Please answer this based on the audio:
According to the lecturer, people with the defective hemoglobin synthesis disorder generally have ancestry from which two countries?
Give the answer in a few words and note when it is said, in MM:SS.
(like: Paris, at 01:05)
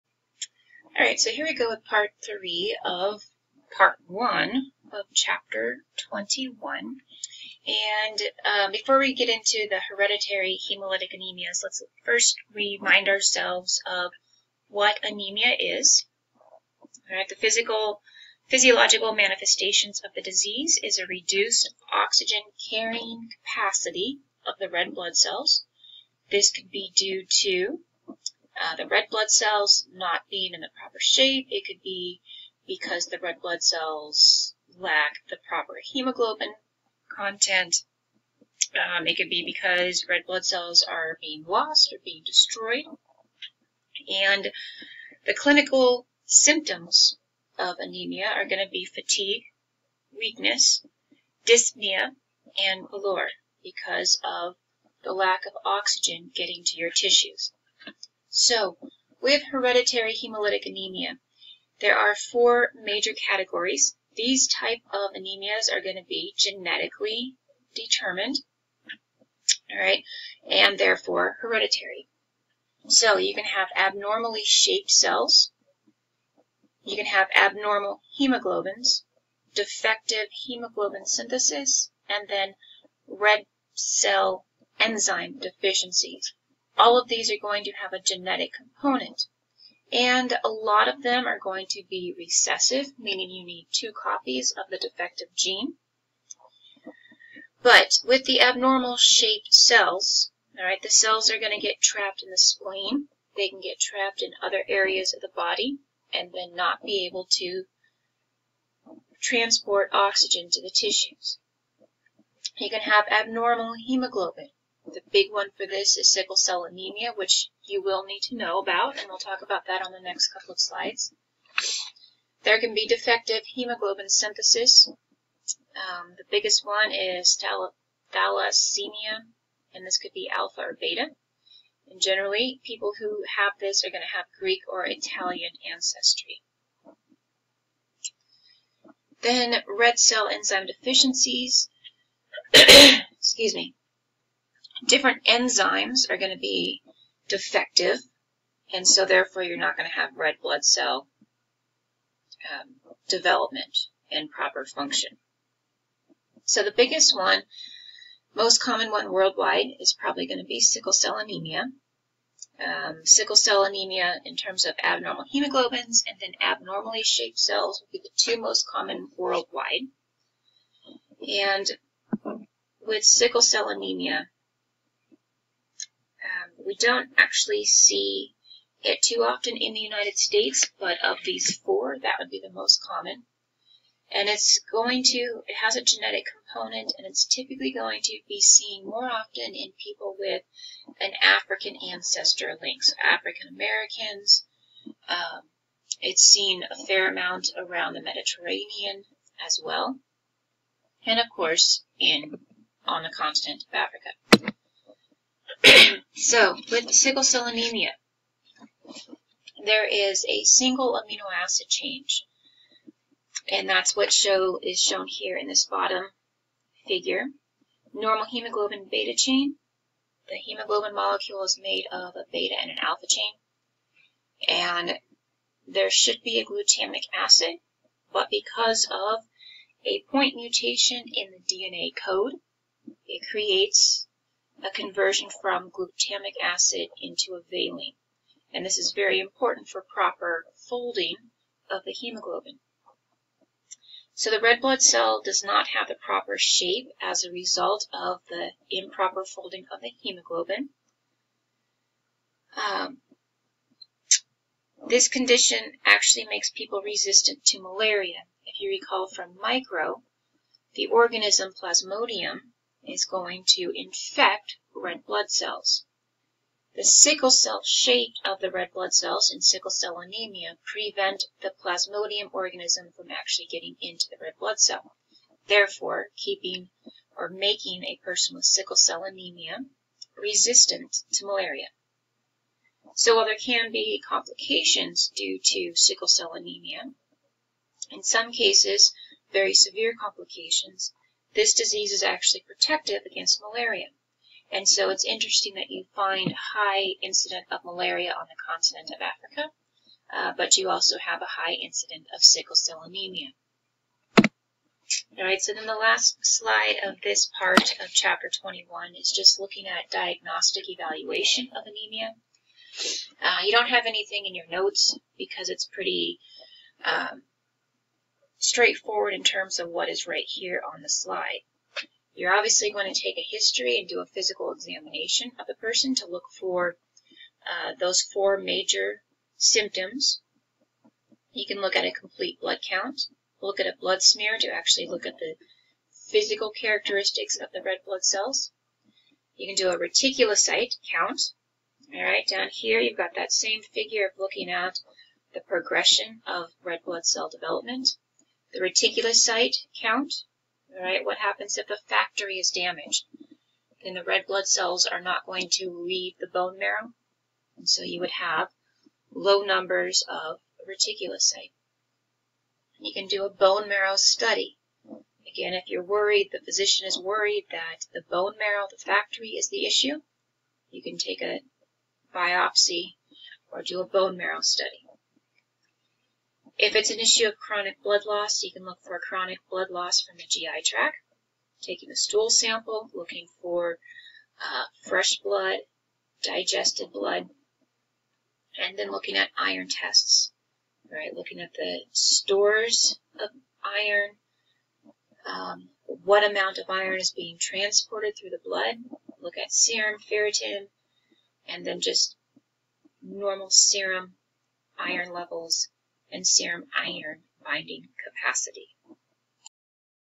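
Greek or Italian, at 02:14.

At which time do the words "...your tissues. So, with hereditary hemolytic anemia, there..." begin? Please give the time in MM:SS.
00:56.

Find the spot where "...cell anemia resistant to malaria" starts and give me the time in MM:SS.
04:38.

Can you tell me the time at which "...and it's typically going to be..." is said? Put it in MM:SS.
03:06.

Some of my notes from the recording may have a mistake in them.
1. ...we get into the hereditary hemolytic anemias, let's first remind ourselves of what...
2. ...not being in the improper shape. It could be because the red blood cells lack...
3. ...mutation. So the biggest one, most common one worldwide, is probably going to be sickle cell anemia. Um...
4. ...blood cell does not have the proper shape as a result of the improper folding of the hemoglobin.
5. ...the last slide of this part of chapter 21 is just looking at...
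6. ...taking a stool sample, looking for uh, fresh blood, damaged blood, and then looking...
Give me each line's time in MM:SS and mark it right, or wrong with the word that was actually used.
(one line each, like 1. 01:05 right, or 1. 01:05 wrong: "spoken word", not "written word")
1. 00:08 right
2. 00:29 wrong: "proper", not "improper"
3. 02:34 wrong: "function", not "mutation"
4. 04:04 right
5. 05:05 right
6. 06:21 wrong: "digested", not "damaged".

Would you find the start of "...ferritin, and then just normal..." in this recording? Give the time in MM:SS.
06:39.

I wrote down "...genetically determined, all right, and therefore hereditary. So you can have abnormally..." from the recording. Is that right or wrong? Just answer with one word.
right.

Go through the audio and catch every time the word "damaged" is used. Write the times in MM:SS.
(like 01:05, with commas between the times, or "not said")
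05:52.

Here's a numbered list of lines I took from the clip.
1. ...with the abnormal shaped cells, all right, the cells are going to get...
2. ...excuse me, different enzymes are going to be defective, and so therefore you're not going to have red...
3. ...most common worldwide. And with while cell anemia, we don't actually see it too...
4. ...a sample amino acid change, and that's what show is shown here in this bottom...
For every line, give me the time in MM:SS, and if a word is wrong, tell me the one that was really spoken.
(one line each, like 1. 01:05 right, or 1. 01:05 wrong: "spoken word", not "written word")
1. 01:38 right
2. 02:22 right
3. 02:48 wrong: "sickle", not "while"
4. 03:30 wrong: "single", not "sample".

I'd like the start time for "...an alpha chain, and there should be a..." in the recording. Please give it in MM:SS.
03:42.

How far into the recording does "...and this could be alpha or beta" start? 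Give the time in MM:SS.
02:09.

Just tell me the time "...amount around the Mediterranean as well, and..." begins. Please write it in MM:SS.
03:17.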